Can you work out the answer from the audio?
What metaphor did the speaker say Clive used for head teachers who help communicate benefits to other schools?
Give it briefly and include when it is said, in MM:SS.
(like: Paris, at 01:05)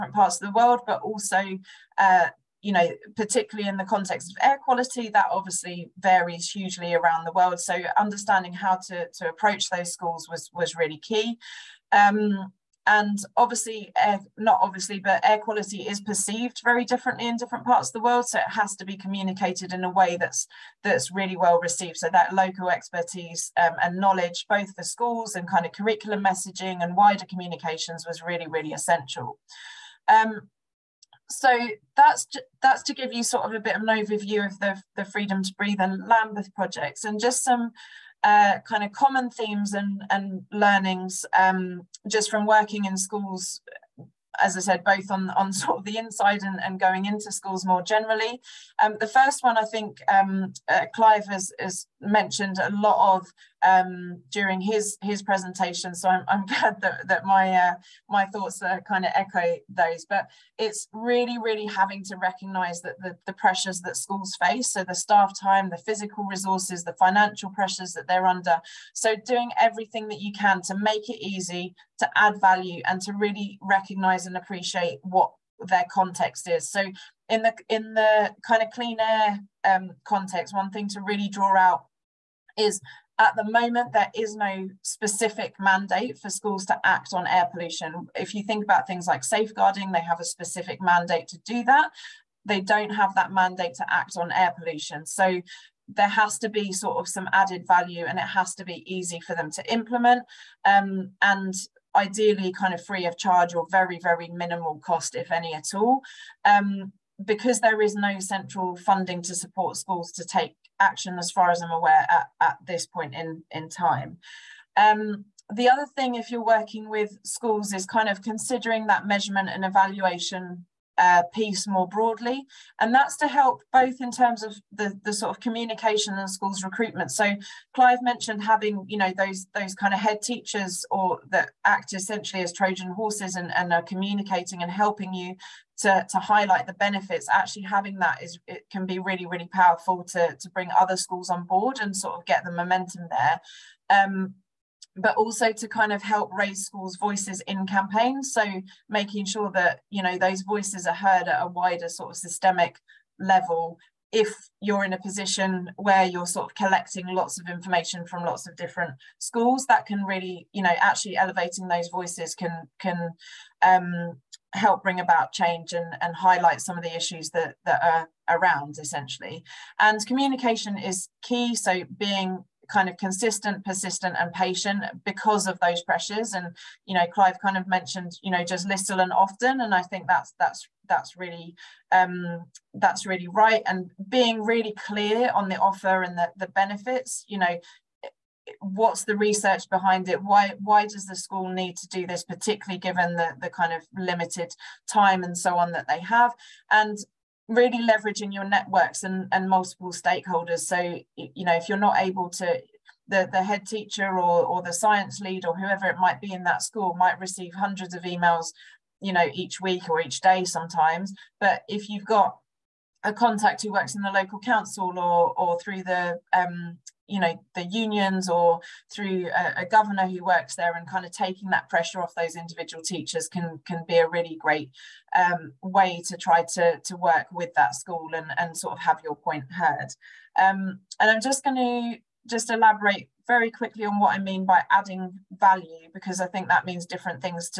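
Trojan horses, at 02:12.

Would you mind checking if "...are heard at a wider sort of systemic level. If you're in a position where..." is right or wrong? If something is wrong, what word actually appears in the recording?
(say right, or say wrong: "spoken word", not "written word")
right.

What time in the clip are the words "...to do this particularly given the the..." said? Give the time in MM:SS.
03:11.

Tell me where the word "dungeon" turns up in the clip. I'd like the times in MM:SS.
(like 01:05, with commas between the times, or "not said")
not said.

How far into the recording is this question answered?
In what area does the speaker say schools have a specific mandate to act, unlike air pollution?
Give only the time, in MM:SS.
01:29.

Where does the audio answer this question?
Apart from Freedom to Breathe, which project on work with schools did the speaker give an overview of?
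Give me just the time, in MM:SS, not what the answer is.
00:36.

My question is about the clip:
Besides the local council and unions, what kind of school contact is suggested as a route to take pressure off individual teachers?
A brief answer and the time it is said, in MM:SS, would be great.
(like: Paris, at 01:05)
a governor, at 03:39.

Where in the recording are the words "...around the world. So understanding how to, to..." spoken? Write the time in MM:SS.
00:06.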